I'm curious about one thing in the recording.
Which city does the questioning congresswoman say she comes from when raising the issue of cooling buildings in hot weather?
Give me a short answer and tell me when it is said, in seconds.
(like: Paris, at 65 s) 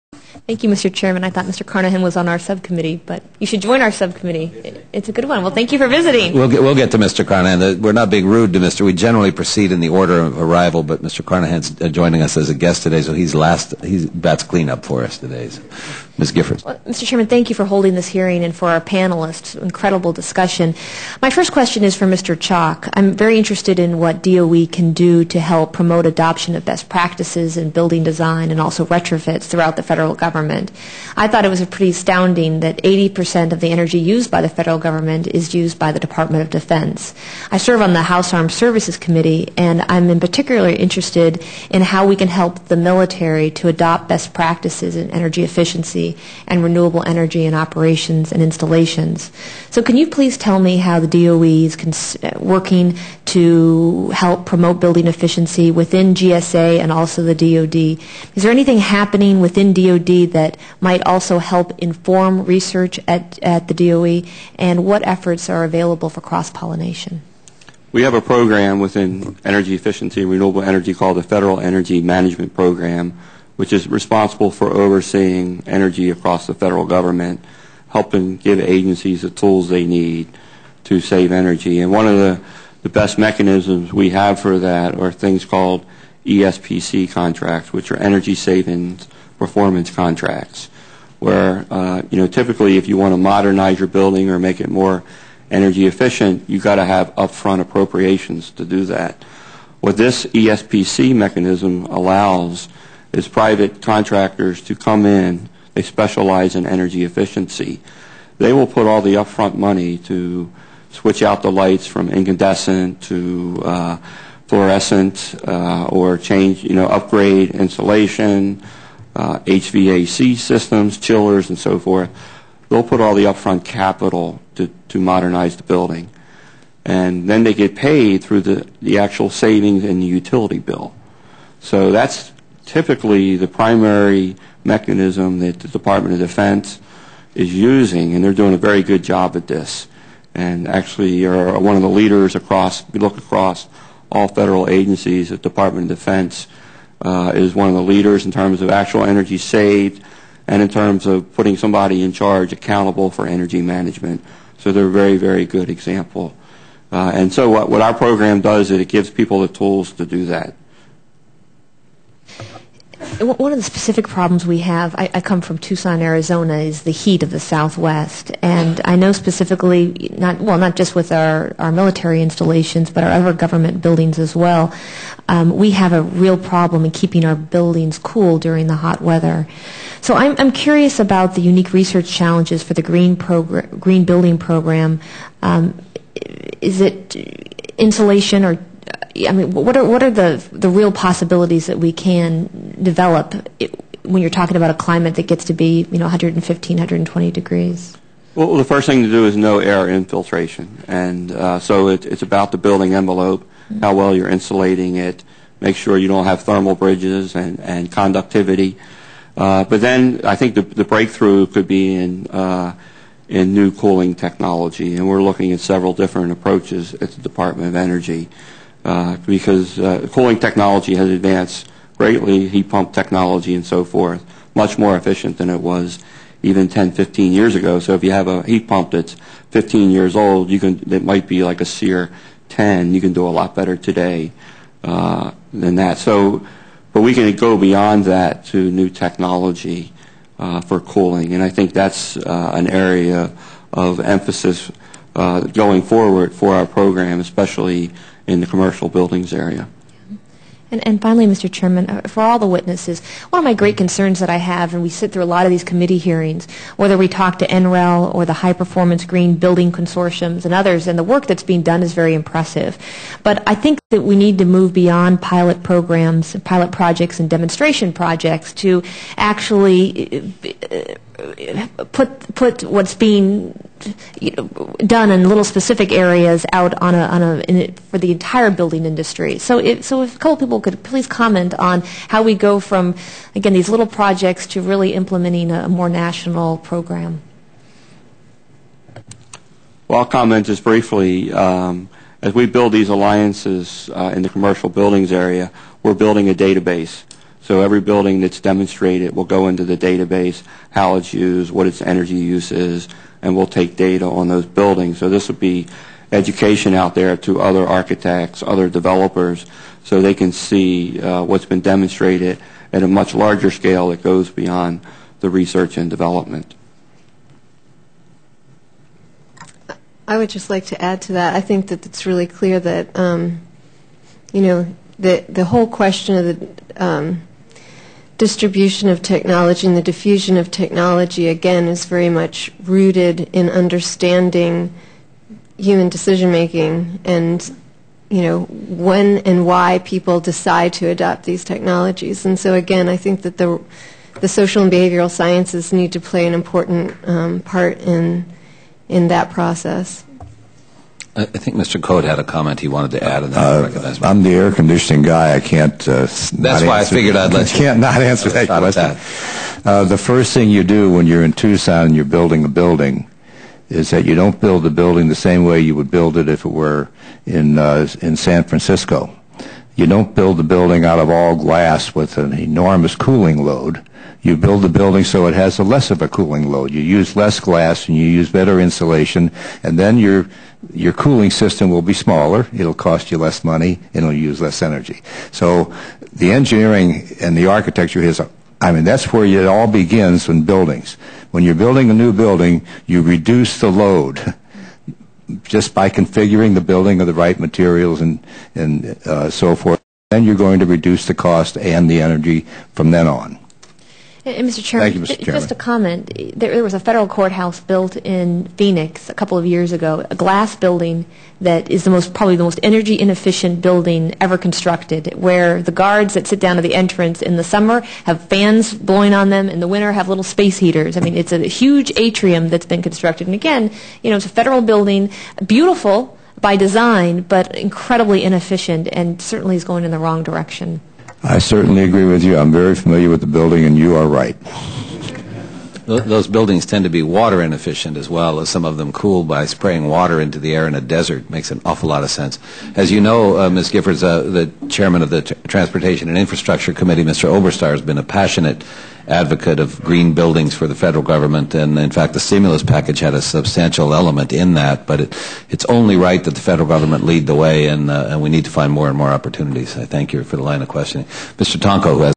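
Tucson, Arizona, at 165 s.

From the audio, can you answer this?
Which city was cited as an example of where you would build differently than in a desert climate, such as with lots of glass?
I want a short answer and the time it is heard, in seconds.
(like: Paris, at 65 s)
San Francisco, at 368 s.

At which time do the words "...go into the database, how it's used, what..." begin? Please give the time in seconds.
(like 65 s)
299 s.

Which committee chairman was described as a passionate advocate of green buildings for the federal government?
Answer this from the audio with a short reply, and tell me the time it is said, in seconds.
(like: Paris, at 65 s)
Oberstar, at 447 s.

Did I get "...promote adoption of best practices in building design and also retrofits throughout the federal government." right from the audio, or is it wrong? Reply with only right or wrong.
right.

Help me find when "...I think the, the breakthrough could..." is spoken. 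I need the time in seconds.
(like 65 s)
210 s.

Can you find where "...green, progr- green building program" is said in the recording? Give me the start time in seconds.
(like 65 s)
182 s.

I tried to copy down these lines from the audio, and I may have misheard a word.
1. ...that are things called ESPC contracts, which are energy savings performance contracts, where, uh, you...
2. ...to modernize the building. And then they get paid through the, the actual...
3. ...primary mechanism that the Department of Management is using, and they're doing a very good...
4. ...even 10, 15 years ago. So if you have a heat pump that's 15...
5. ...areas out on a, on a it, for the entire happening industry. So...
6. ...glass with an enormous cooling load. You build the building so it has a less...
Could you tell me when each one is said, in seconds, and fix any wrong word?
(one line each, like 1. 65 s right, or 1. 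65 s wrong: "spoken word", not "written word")
1. 84 s right
2. 124 s right
3. 133 s wrong: "Defense", not "Management"
4. 226 s right
5. 275 s wrong: "building", not "happening"
6. 371 s right.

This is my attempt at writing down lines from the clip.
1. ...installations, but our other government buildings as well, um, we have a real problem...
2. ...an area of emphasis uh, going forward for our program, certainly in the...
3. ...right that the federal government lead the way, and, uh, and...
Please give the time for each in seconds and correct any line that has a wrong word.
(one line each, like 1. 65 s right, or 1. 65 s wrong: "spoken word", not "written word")
1. 172 s right
2. 242 s wrong: "especially", not "certainly"
3. 455 s right.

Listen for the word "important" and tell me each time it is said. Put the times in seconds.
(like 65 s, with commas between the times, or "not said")
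346 s.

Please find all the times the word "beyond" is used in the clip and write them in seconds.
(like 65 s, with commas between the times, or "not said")
237 s, 264 s, 314 s.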